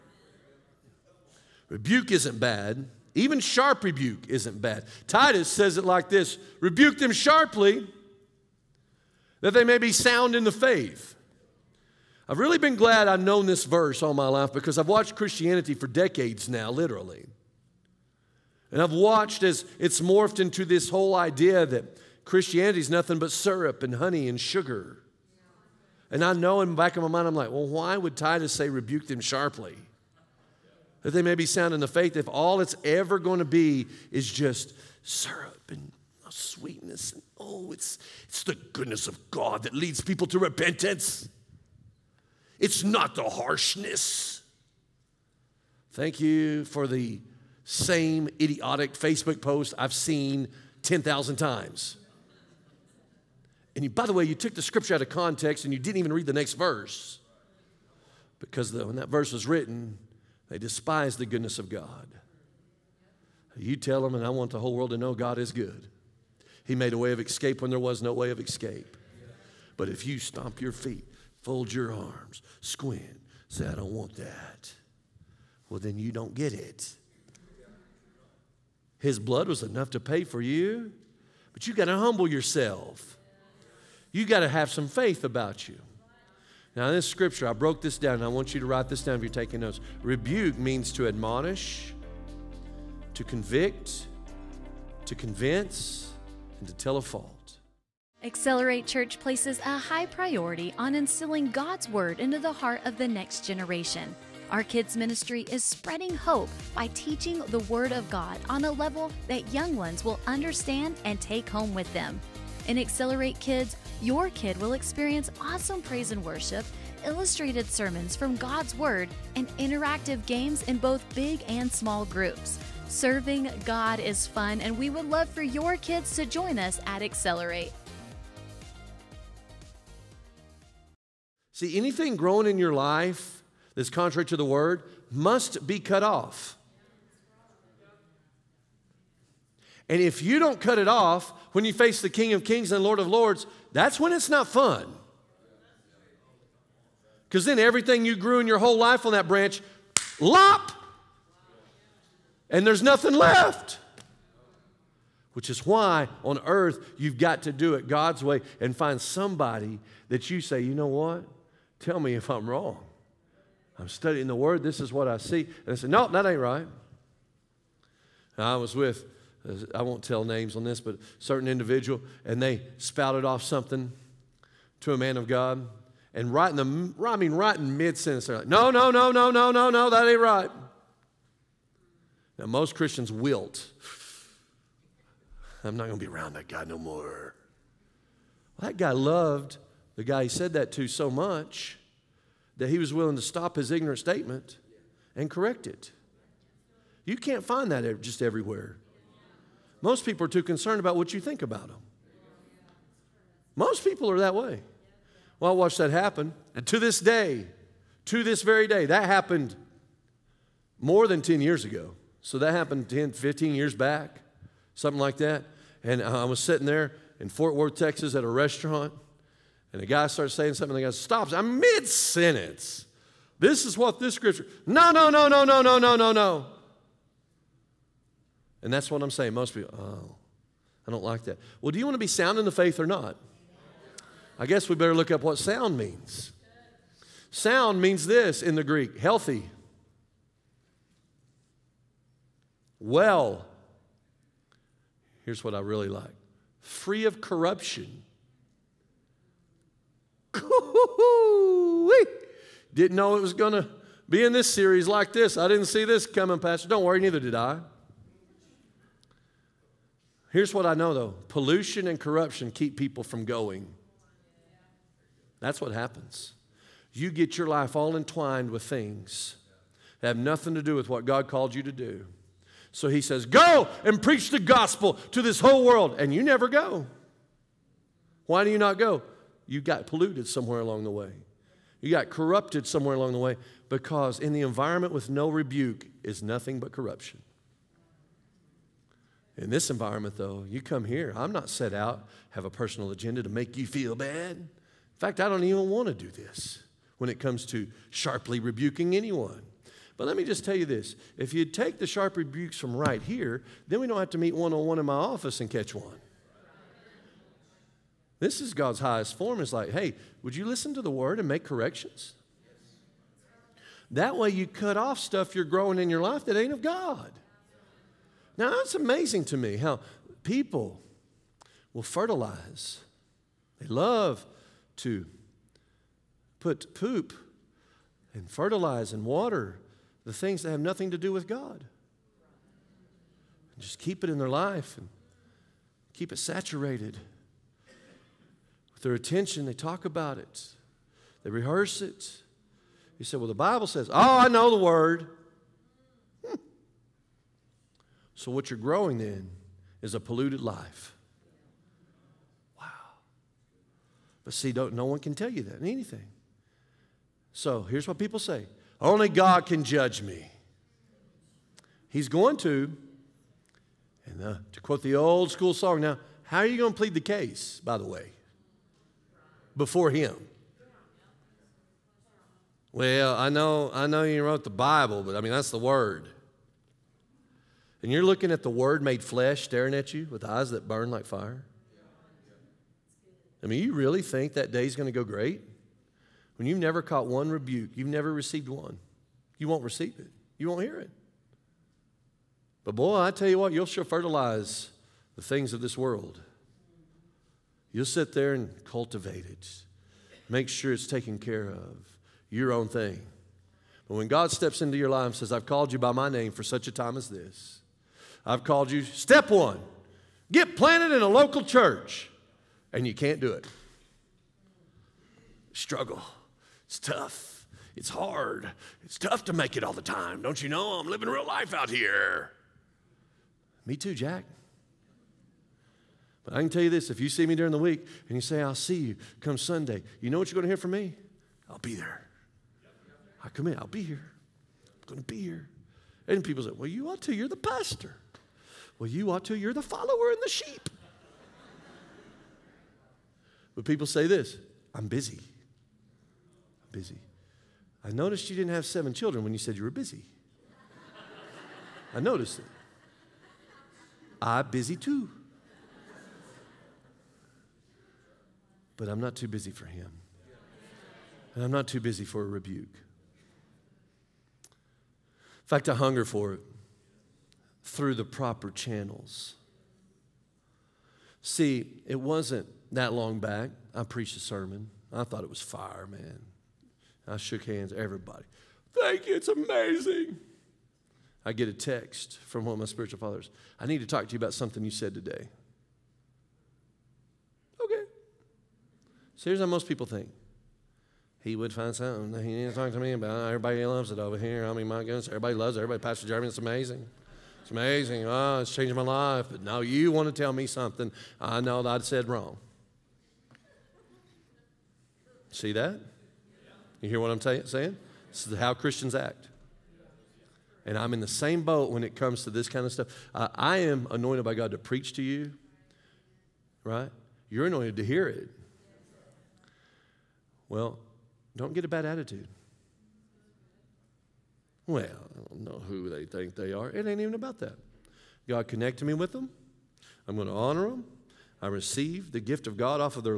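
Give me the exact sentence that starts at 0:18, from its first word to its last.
And I've watched as it's morphed into this whole idea that Christianity is nothing but syrup and honey and sugar.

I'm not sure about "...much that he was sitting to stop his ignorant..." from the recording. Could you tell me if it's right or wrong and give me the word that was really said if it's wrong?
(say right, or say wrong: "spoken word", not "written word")
wrong: "willing", not "sitting".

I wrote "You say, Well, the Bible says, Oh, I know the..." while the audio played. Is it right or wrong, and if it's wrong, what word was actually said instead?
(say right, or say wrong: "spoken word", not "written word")
right.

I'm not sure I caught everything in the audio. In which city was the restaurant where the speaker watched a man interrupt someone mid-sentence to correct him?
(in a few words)
Fort Worth, Texas.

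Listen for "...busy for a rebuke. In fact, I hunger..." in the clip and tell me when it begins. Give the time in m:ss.
7:41.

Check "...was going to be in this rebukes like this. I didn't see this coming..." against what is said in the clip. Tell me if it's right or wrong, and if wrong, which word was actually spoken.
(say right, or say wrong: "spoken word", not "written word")
wrong: "series", not "rebukes".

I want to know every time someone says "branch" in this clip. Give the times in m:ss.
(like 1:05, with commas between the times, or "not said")
2:29.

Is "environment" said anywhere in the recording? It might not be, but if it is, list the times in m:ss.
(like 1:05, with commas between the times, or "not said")
4:44, 4:49.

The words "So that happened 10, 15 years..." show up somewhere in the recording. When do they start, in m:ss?
3:32.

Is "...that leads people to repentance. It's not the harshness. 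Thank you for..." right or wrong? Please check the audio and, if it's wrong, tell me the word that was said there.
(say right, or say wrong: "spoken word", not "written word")
right.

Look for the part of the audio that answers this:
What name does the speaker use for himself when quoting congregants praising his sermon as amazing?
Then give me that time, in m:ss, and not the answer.
8:15.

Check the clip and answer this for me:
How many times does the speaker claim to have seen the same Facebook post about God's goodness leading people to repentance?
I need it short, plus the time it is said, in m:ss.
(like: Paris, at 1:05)
10,000, at 0:50.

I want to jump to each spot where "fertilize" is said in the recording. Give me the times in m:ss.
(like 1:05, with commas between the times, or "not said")
5:21, 5:28, 6:33.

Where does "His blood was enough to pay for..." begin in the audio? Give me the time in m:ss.
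1:18.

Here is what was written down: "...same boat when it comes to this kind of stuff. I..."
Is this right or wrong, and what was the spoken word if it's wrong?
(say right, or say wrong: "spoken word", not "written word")
right.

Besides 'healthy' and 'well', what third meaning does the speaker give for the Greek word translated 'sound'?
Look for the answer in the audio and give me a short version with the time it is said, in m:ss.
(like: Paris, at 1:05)
free of corruption, at 4:06.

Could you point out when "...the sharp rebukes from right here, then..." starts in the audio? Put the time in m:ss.
5:01.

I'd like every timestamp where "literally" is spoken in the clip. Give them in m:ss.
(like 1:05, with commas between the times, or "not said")
0:16.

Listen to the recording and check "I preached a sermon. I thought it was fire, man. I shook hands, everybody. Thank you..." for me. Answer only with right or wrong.
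right.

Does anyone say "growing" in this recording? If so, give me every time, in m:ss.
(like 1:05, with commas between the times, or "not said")
2:12, 5:15, 5:48.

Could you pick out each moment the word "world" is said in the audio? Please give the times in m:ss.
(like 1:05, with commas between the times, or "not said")
1:04, 4:35, 6:35.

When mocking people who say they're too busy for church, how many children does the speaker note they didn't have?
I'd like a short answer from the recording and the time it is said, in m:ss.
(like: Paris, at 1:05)
seven, at 7:28.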